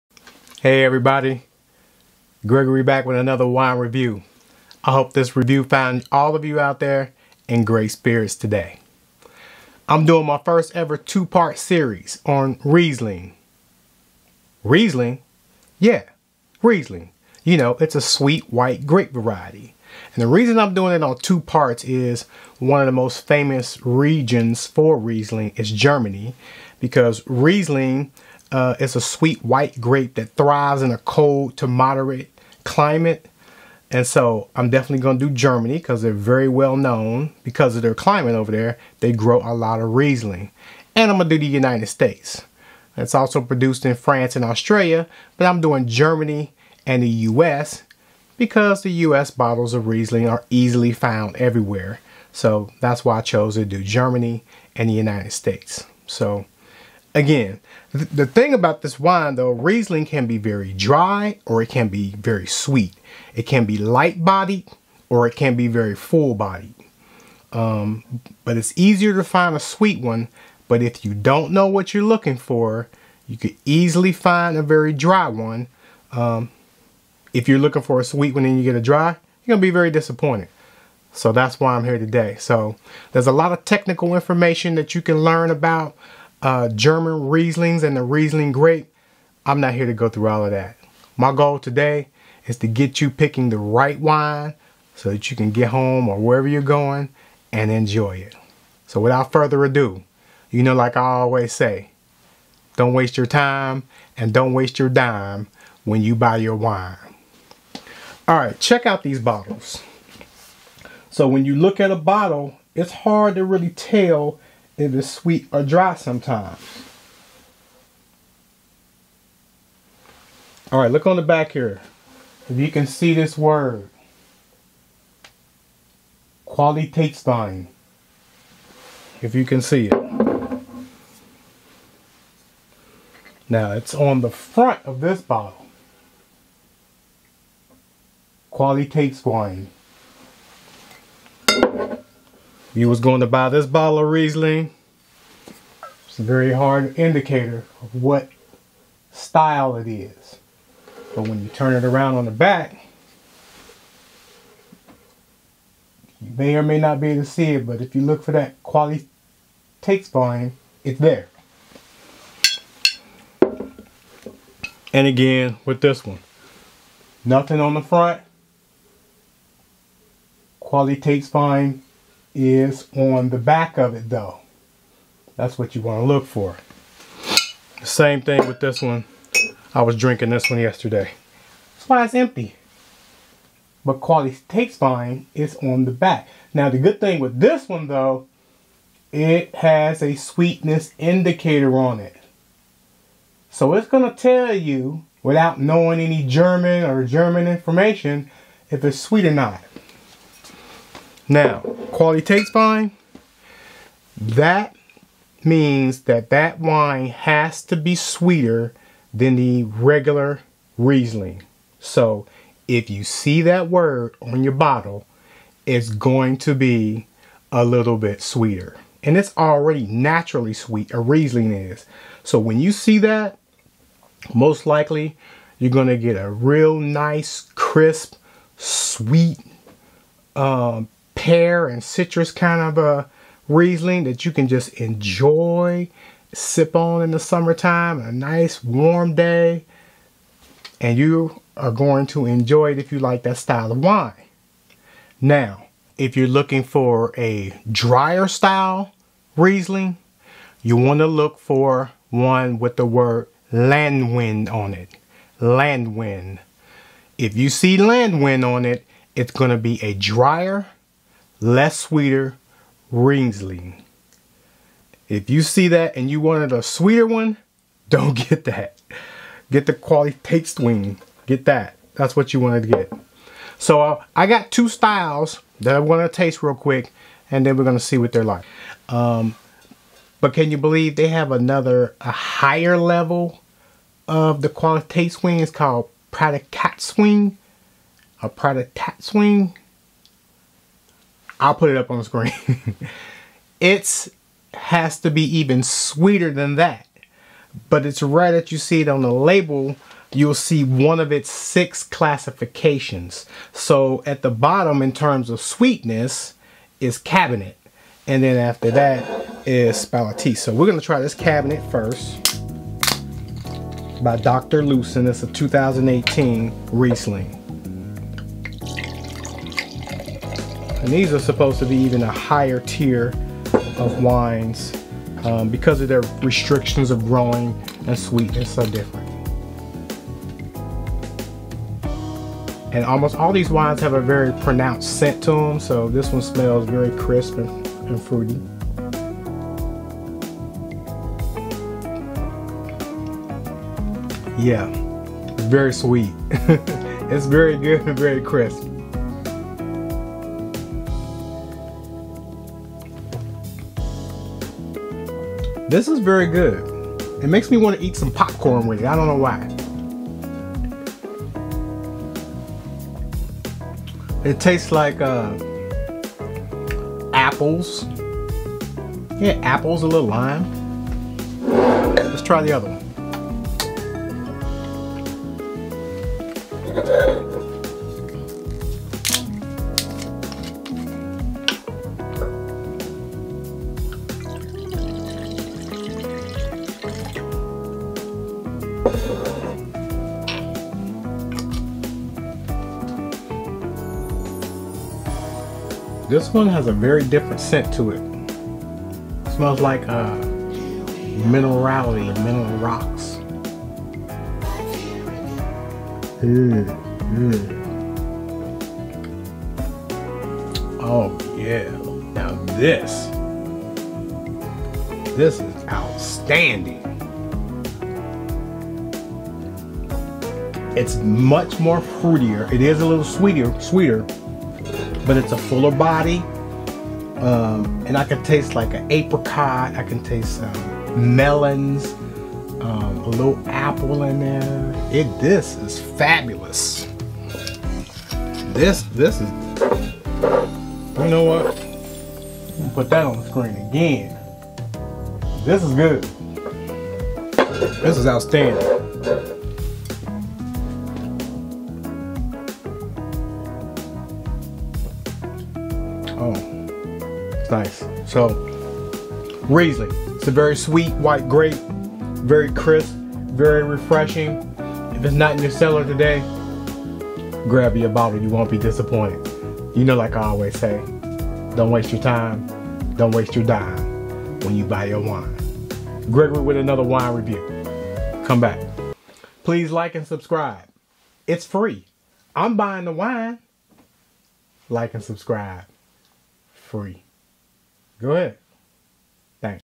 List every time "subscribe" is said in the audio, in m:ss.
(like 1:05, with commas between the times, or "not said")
8:00, 8:05.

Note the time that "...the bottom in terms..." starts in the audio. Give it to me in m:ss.
5:04.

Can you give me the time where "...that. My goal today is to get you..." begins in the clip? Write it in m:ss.
1:30.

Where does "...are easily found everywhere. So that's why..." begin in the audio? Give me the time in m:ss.
0:50.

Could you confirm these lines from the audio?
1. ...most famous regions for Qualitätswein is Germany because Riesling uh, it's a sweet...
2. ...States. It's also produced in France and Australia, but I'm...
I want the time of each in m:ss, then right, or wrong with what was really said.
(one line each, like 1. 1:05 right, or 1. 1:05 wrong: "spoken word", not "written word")
1. 0:22 wrong: "Riesling", not "Qualitätswein"
2. 0:41 right.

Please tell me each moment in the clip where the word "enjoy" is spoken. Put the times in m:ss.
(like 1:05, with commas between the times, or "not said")
1:37, 3:54, 4:02.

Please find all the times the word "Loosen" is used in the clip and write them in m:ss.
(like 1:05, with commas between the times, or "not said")
5:14.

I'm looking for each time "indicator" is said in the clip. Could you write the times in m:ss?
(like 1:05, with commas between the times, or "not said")
2:26, 3:10.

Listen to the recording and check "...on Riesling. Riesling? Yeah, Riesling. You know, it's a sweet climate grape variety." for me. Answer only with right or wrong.
wrong.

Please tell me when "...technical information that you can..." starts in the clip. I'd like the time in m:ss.
1:23.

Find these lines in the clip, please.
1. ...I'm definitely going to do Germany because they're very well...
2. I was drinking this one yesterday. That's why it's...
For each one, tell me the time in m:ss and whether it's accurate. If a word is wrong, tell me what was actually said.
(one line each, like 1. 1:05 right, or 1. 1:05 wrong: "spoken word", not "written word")
1. 0:34 right
2. 2:59 right.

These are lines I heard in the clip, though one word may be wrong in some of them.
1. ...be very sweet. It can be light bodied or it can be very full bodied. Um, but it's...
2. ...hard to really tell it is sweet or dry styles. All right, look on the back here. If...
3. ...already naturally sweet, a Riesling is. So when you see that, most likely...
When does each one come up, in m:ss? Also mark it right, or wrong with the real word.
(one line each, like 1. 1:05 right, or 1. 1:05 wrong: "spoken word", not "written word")
1. 1:01 right
2. 1:52 wrong: "sometimes", not "styles"
3. 3:39 right.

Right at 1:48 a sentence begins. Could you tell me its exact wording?
All right, check out these bottles.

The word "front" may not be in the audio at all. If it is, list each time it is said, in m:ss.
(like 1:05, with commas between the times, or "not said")
2:14, 2:47.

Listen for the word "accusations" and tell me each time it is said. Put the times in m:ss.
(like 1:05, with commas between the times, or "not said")
not said.